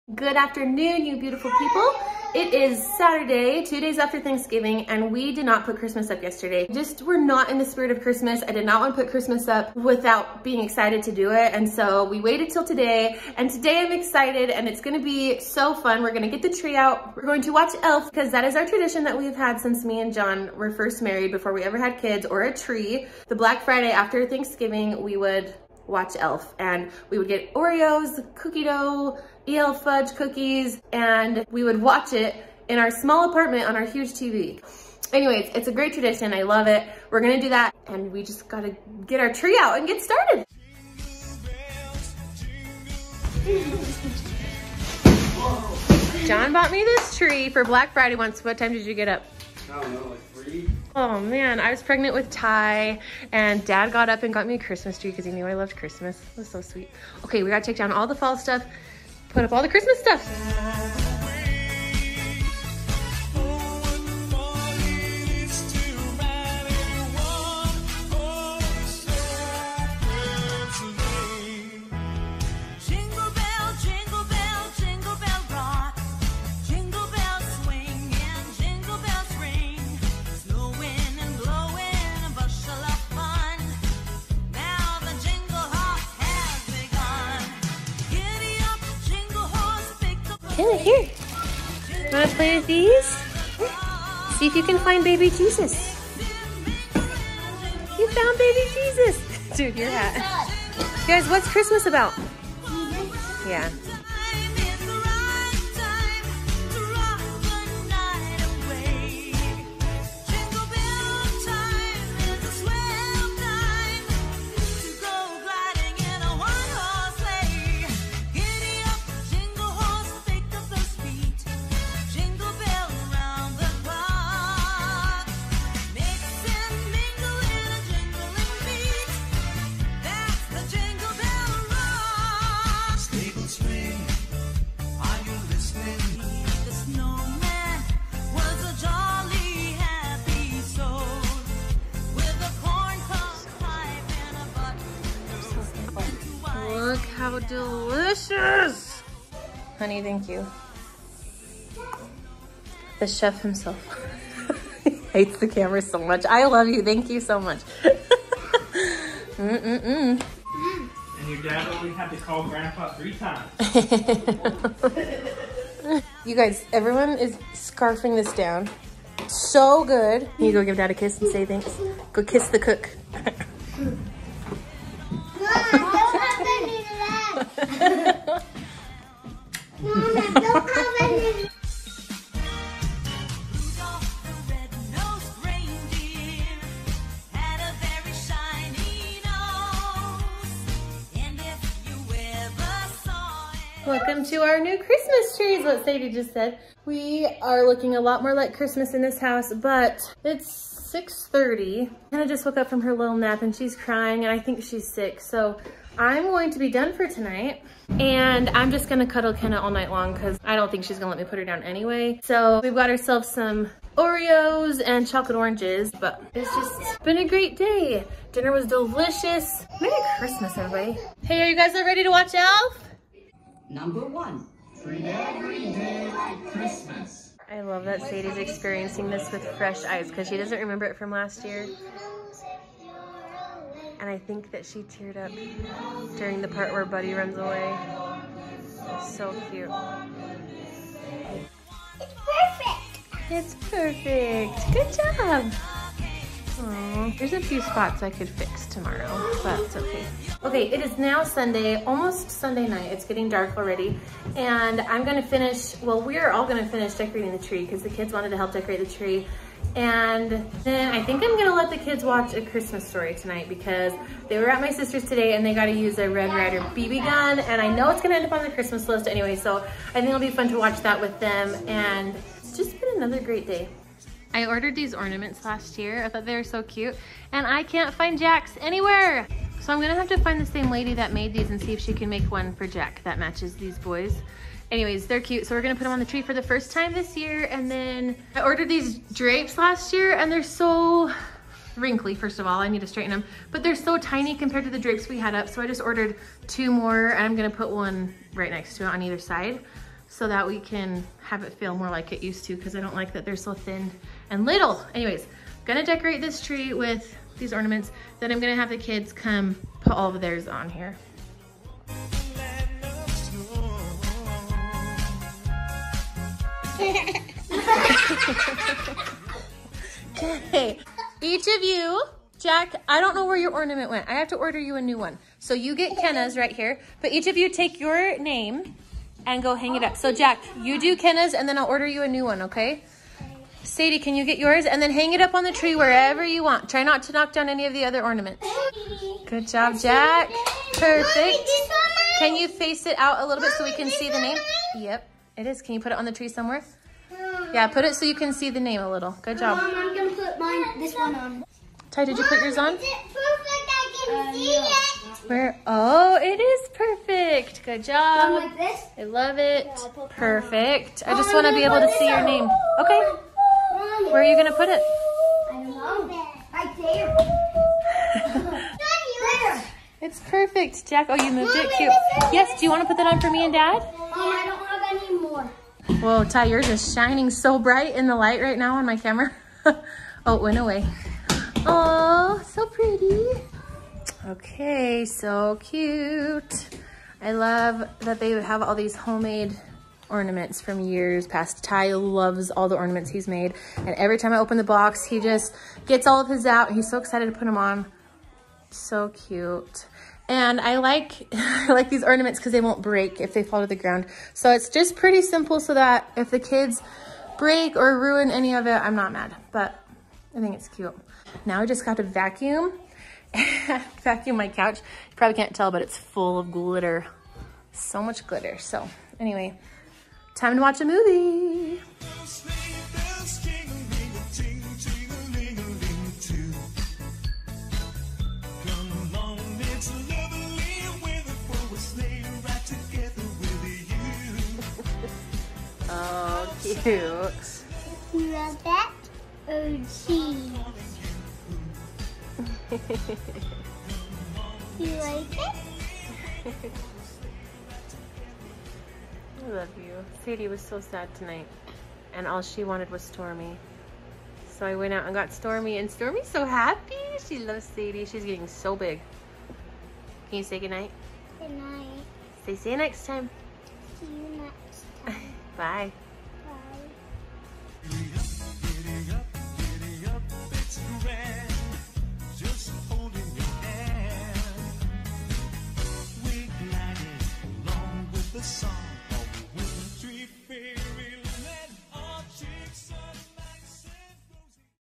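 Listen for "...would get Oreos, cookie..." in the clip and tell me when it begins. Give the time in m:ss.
0:27.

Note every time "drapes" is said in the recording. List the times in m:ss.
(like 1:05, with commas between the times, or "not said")
4:49, 4:54.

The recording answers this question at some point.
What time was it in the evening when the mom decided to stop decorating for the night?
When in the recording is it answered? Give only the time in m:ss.
3:20.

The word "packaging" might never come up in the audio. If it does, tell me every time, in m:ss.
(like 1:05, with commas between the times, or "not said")
not said.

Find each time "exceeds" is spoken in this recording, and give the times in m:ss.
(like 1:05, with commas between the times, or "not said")
not said.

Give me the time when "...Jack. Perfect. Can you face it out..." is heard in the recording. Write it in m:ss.
5:39.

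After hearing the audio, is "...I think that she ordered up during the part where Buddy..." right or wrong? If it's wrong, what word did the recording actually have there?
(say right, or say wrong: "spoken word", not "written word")
wrong: "teared", not "ordered".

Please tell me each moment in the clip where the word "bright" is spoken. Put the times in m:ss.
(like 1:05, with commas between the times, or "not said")
6:17.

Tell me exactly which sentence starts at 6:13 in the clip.
Mom, I don't have any more.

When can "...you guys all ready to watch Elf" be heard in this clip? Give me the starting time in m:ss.
3:41.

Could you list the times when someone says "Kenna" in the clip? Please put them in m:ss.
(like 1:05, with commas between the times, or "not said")
3:29, 5:25, 5:30.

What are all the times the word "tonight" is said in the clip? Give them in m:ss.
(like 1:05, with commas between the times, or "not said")
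3:27, 4:23, 7:31.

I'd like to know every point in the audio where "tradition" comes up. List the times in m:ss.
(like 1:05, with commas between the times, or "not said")
0:18, 0:35.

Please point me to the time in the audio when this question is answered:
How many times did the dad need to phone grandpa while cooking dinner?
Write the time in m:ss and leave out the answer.
2:42.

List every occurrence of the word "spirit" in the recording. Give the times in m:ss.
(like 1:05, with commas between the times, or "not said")
0:07.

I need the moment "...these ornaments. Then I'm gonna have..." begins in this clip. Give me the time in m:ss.
5:07.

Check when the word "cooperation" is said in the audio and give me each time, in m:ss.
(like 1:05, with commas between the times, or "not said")
not said.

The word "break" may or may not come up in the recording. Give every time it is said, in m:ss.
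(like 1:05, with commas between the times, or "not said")
6:42, 6:47.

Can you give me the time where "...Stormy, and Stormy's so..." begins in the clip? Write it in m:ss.
7:35.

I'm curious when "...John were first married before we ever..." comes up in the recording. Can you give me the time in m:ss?
0:20.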